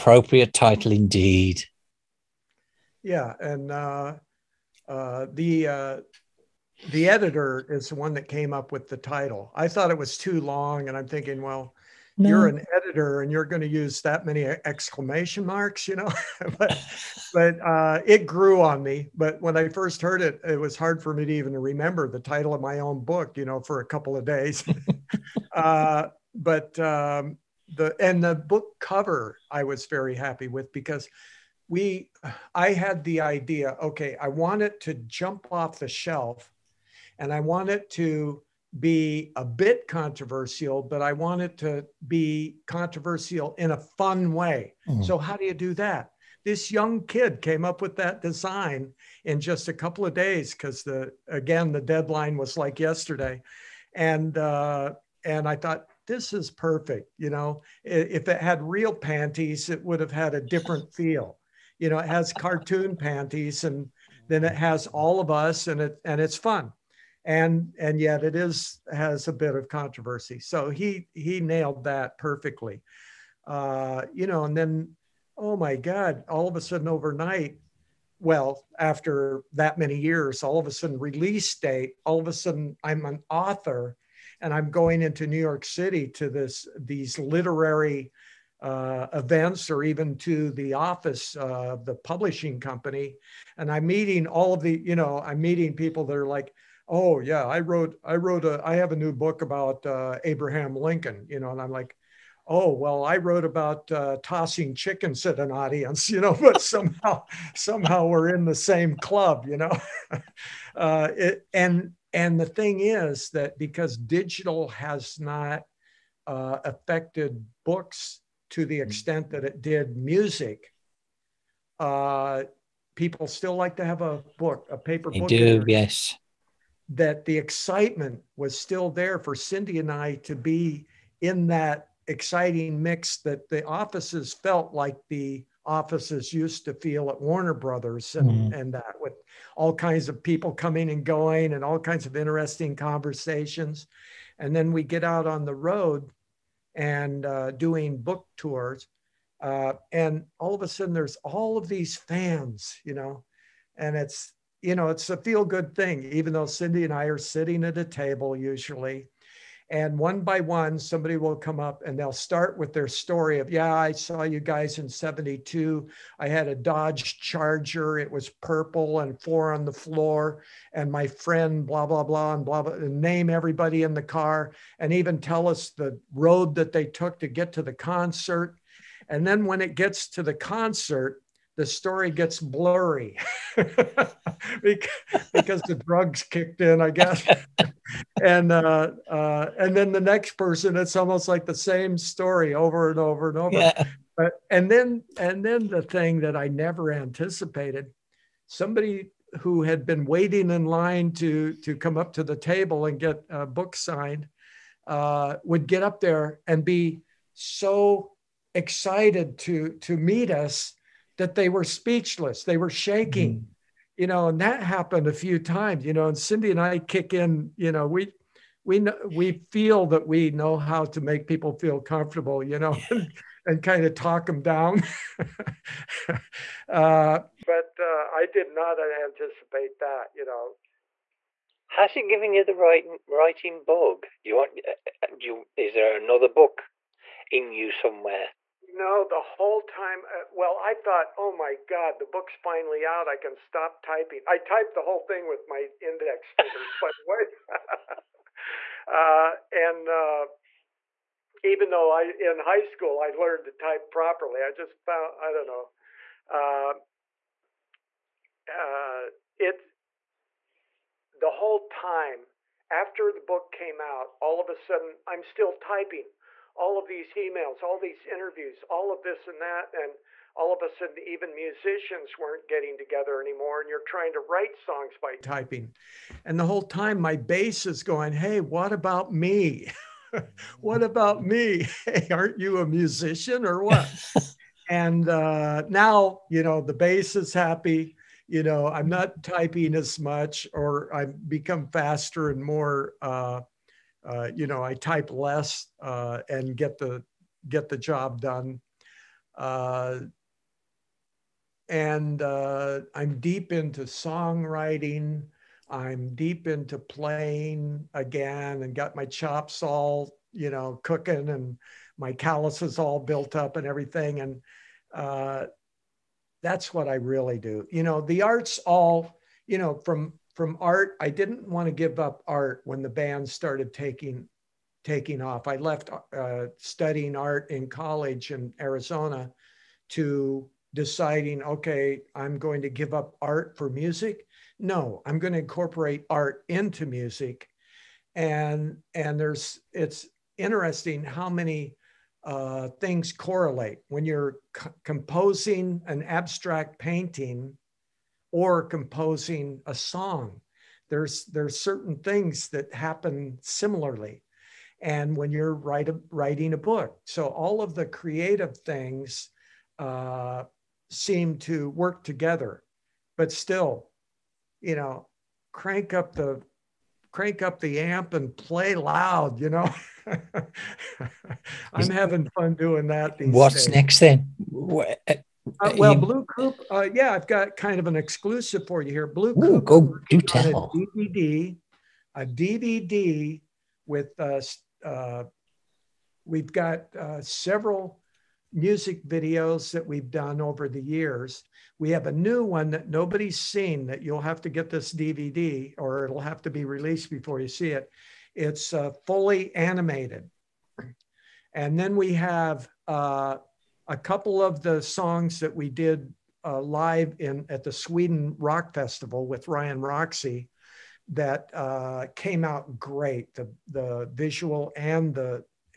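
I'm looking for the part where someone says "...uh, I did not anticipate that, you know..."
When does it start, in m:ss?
3:47.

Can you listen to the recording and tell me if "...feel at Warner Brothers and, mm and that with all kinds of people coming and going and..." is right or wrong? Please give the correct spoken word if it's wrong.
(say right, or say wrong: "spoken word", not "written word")
right.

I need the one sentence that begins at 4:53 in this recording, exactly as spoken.
Uh, uh, you know, I type less uh, and get the get the job done.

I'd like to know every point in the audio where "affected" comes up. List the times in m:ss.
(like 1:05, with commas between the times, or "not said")
1:56.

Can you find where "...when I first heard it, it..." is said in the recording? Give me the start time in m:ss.
0:19.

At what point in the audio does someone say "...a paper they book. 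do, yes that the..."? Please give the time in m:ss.
2:04.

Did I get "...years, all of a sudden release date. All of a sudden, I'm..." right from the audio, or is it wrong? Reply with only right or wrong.
right.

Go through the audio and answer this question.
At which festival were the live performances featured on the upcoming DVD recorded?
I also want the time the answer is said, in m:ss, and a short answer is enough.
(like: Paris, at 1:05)
Sweden Rock Festival, at 6:47.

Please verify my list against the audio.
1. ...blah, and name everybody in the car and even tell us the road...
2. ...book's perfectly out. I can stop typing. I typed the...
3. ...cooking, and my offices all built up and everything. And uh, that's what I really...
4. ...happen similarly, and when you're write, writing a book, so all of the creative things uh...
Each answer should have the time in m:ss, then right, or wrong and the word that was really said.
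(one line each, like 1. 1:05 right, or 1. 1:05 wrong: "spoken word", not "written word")
1. 2:52 right
2. 4:02 wrong: "finally", not "perfectly"
3. 5:10 wrong: "calluses", not "offices"
4. 5:52 right.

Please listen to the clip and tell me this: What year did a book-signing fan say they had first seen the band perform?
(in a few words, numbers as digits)
1972.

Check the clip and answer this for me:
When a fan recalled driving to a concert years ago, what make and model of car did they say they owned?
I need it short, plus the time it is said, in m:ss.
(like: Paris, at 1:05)
Dodge Charger, at 2:46.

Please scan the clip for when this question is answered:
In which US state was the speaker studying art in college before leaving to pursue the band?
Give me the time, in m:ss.
5:28.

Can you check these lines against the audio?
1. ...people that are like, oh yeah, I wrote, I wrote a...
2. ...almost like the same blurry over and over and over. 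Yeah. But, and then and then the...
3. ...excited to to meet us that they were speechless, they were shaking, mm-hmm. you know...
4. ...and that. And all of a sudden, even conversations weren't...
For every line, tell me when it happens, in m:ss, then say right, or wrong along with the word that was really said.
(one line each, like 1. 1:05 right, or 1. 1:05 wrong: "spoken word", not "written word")
1. 1:35 right
2. 3:10 wrong: "story", not "blurry"
3. 3:28 right
4. 4:29 wrong: "musicians", not "conversations".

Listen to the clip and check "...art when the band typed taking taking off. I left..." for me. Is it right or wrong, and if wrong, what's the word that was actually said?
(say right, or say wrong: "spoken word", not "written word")
wrong: "started", not "typed".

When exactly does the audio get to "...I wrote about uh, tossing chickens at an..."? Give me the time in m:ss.
1:43.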